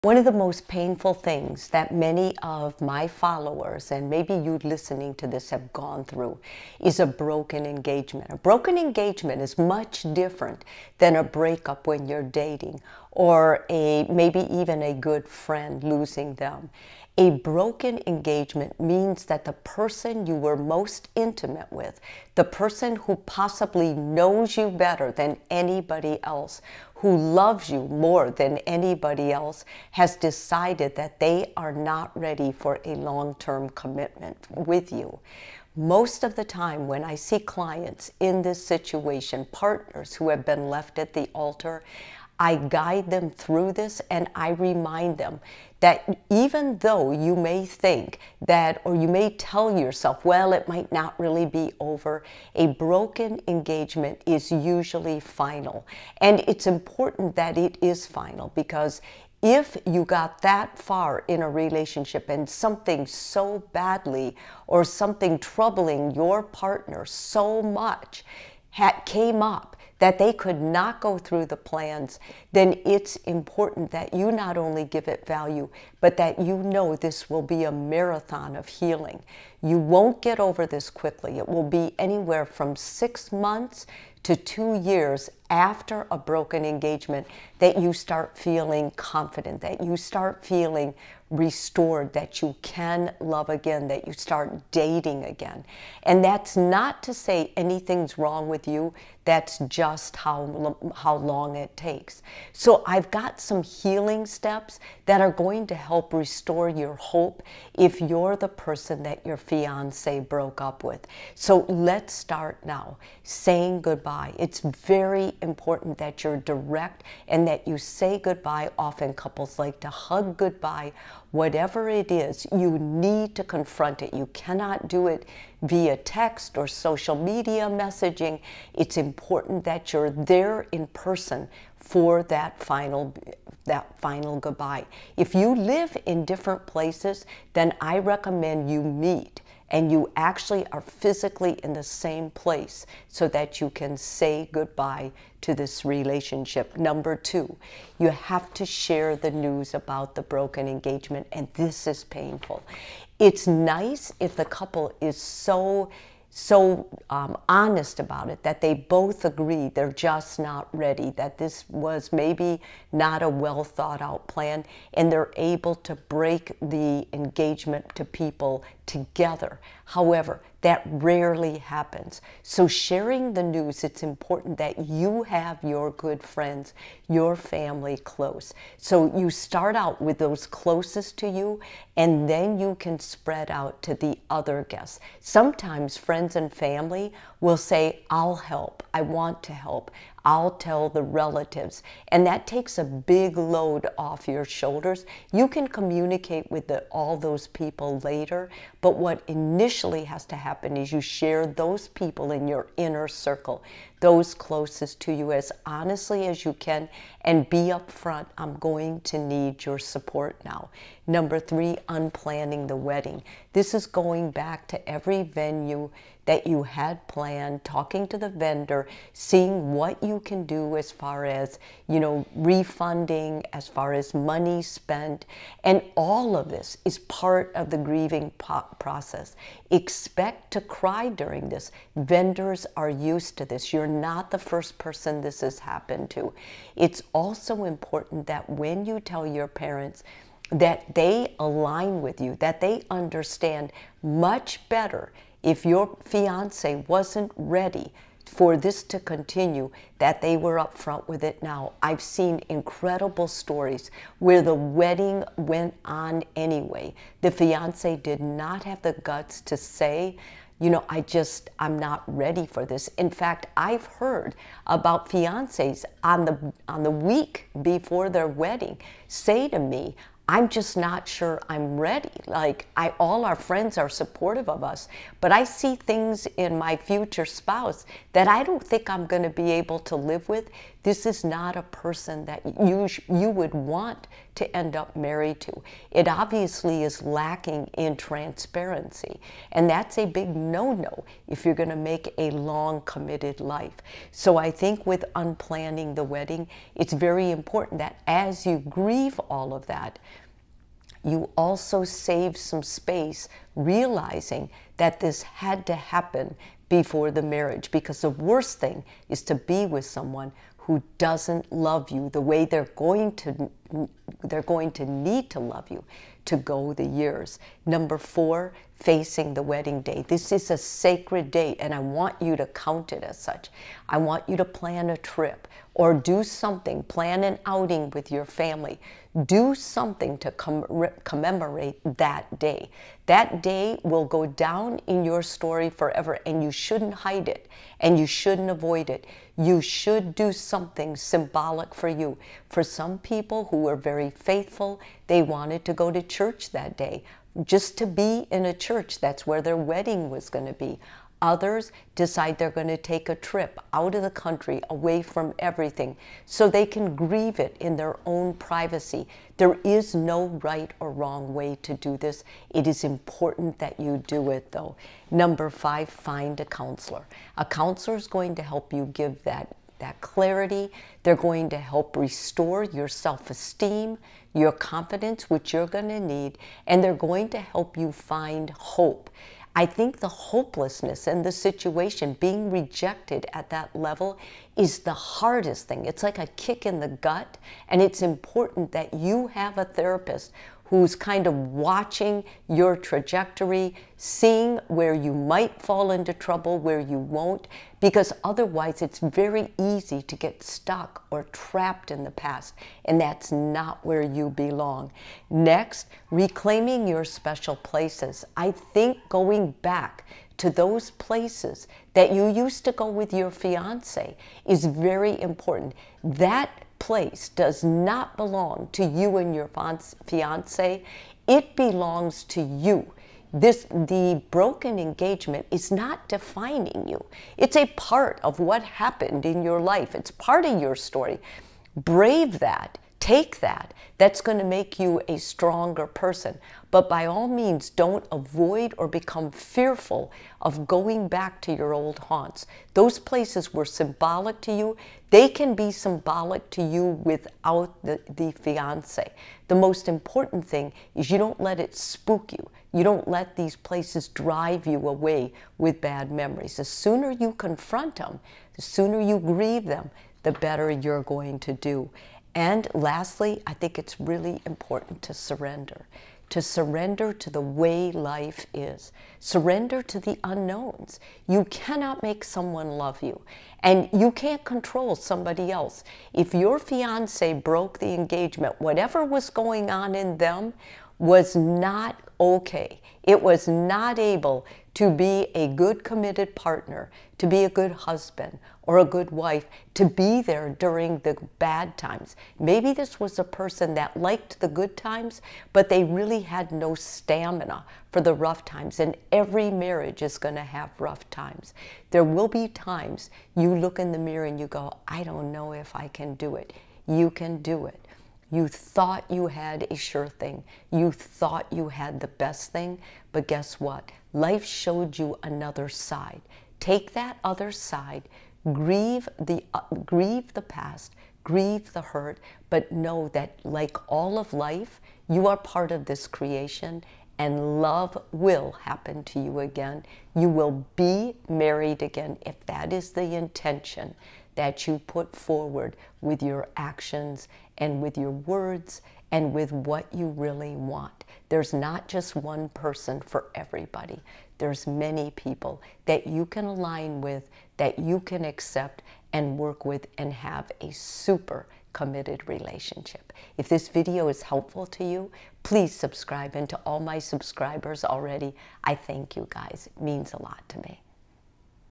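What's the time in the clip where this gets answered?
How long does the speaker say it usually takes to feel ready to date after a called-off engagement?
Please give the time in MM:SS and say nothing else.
01:22.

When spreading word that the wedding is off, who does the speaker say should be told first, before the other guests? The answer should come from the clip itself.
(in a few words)
inner circle.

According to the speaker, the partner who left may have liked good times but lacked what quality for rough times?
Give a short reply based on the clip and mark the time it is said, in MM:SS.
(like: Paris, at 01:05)
stamina, at 08:16.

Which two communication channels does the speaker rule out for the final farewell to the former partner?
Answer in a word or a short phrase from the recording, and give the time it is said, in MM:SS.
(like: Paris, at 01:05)
text or social media messaging, at 02:05.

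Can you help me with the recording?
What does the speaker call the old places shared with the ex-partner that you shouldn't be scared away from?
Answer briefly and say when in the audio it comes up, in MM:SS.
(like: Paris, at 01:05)
old haunts, at 07:21.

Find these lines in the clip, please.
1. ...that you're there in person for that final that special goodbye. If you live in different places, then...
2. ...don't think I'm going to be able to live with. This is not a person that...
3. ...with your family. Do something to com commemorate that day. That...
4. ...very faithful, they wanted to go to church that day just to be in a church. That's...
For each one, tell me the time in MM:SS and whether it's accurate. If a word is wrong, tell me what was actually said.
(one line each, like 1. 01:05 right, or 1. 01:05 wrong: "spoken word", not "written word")
1. 02:09 wrong: "final", not "special"
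2. 04:38 right
3. 05:27 right
4. 05:43 right.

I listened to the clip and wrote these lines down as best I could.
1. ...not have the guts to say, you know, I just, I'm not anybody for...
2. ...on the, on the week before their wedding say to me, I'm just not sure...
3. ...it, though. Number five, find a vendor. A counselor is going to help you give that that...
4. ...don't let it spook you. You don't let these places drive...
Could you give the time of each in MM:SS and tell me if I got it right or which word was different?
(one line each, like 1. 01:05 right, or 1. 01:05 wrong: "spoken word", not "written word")
1. 04:18 wrong: "ready", not "anybody"
2. 04:26 right
3. 06:04 wrong: "counselor", not "vendor"
4. 07:31 right.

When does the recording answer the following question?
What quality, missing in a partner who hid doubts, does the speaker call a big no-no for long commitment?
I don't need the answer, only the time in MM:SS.
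04:47.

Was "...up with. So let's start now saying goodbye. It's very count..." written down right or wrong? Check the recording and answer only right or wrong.
wrong.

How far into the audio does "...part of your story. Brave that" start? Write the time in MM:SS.
07:10.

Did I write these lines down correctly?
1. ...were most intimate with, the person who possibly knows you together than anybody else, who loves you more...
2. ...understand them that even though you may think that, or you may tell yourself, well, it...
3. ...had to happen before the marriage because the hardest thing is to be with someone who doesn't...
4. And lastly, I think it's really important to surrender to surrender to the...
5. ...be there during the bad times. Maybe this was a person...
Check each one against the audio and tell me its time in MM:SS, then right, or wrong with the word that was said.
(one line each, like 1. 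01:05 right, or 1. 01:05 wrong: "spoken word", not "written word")
1. 00:20 wrong: "better", not "together"
2. 00:44 wrong: "remind", not "understand"
3. 05:05 wrong: "worst", not "hardest"
4. 07:42 right
5. 08:09 right.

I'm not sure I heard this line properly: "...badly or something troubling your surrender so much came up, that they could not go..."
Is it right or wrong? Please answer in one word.
wrong.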